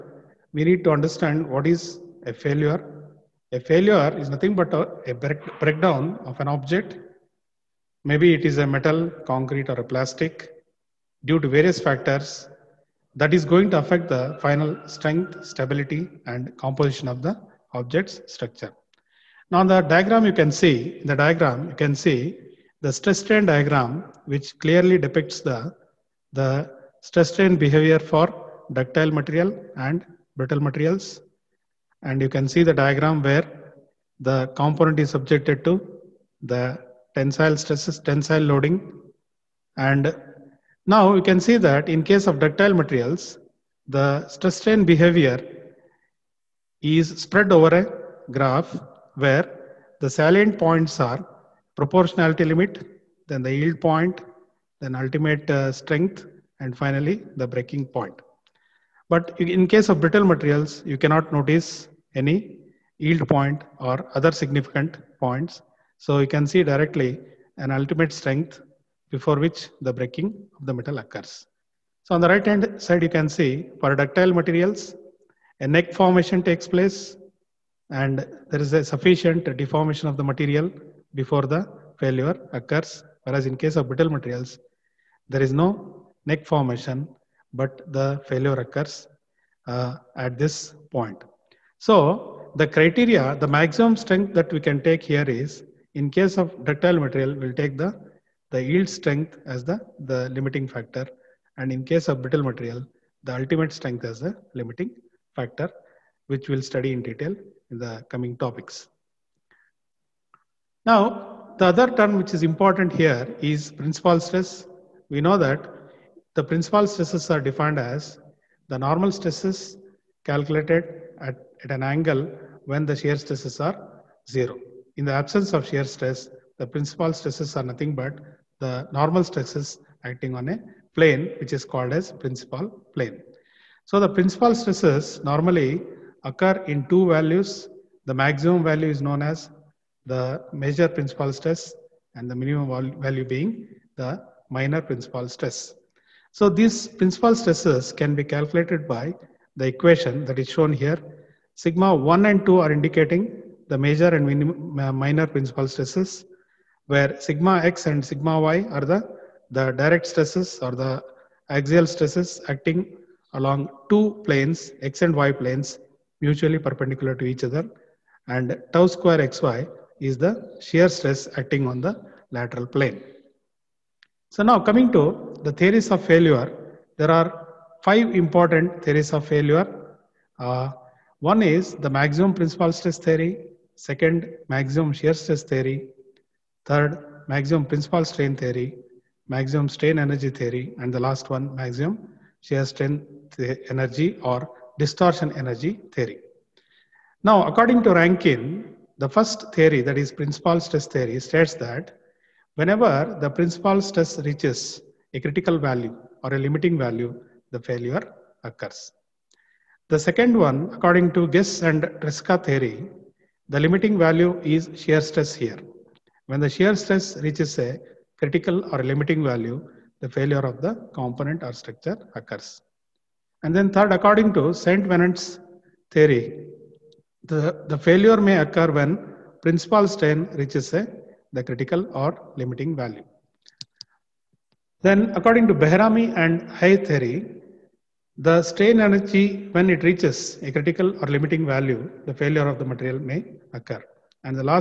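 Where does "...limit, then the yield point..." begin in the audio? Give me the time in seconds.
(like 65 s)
52 s.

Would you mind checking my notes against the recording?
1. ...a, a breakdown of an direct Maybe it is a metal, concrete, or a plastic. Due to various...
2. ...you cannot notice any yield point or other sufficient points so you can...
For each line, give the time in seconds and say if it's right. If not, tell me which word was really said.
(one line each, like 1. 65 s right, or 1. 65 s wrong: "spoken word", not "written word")
1. 4 s wrong: "object", not "direct"
2. 60 s wrong: "significant", not "sufficient".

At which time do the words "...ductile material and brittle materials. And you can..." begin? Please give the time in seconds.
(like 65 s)
28 s.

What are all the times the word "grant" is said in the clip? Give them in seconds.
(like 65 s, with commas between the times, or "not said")
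not said.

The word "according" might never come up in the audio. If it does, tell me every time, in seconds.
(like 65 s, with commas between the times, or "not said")
197 s, 210 s, 223 s, 235 s.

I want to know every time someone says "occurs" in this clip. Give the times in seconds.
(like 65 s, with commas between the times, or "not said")
70 s, 82 s, 88 s, 136 s, 208 s, 222 s, 228 s, 243 s.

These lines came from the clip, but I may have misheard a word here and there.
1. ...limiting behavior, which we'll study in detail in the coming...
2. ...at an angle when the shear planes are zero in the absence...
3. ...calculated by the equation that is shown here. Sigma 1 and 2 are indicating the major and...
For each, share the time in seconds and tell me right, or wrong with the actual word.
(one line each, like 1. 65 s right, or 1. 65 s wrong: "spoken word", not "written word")
1. 104 s wrong: "factor", not "behavior"
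2. 121 s wrong: "stresses", not "planes"
3. 148 s right.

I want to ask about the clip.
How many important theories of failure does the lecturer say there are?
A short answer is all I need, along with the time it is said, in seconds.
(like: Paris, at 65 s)
5, at 177 s.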